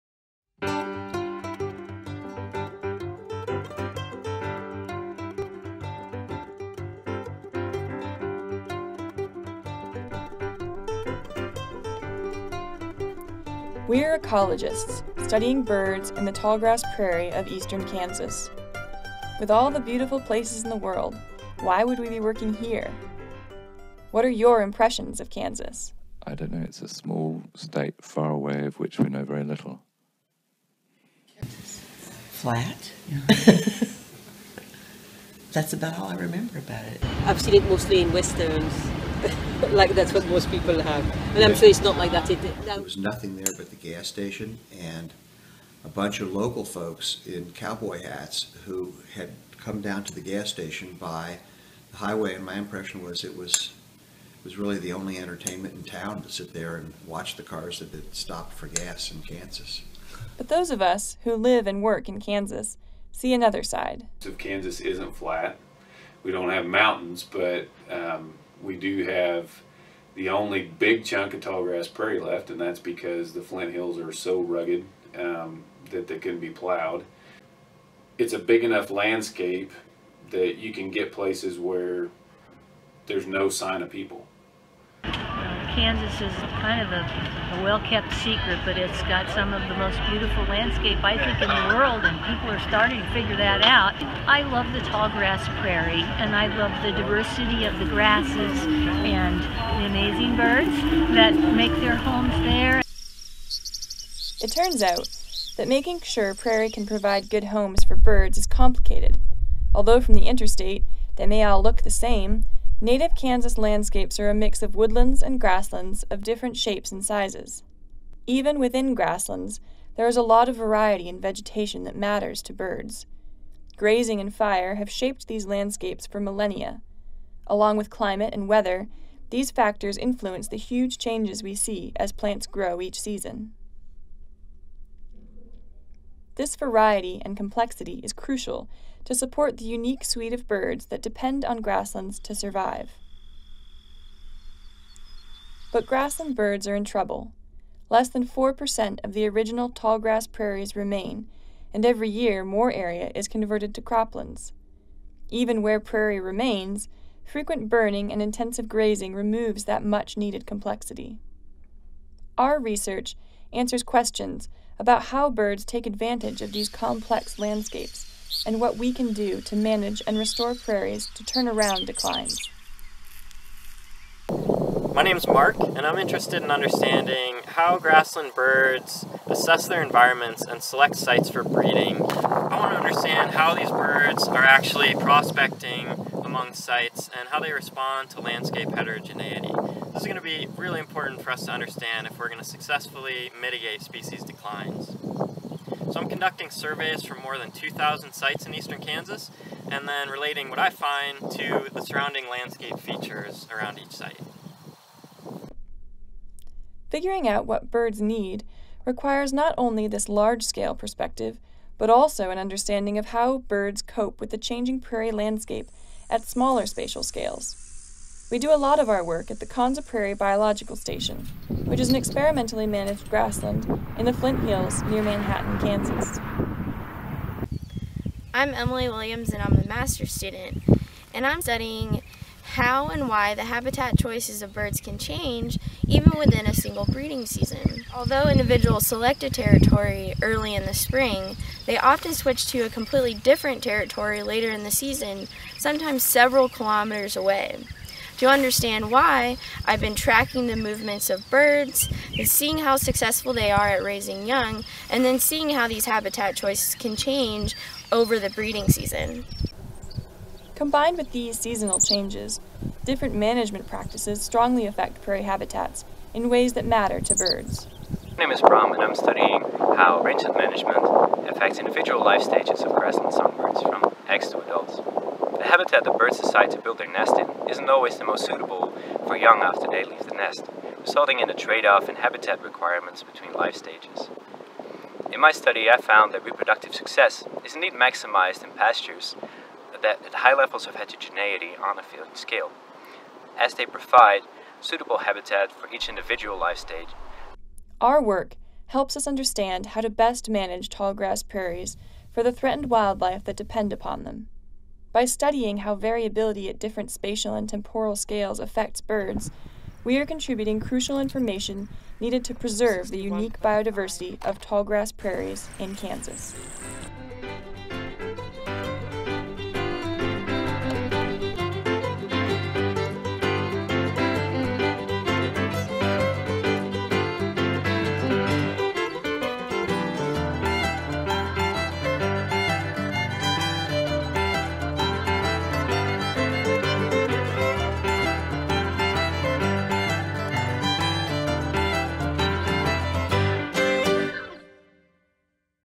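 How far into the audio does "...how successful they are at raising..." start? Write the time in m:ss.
4:12.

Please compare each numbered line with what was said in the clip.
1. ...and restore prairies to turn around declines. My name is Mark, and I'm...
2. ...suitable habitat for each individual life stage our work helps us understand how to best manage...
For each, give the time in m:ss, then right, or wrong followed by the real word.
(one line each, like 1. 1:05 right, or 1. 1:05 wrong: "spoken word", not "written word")
1. 2:50 right
2. 4:54 right.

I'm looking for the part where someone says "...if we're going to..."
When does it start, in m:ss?
3:12.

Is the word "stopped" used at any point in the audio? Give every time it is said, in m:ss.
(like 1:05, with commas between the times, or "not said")
0:58.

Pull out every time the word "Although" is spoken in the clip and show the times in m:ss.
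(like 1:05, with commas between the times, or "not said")
1:49, 3:58.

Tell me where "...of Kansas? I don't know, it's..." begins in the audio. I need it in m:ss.
0:25.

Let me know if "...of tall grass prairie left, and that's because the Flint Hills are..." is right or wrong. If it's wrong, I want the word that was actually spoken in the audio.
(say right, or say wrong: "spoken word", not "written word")
right.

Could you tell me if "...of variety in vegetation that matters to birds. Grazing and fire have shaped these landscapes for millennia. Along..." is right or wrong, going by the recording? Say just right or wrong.
right.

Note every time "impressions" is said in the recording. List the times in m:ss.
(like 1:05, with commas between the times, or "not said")
0:24, 0:52.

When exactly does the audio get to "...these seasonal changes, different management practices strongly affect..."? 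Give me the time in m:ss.
4:21.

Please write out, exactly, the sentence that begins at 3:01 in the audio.
I want to understand how these birds are actually prospecting among sites and how they respond to landscape heterogeneity.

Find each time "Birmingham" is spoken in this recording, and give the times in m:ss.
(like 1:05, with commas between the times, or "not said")
not said.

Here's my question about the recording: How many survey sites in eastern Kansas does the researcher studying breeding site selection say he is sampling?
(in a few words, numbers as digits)
more than 2,000.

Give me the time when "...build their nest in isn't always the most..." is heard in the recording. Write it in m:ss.
4:36.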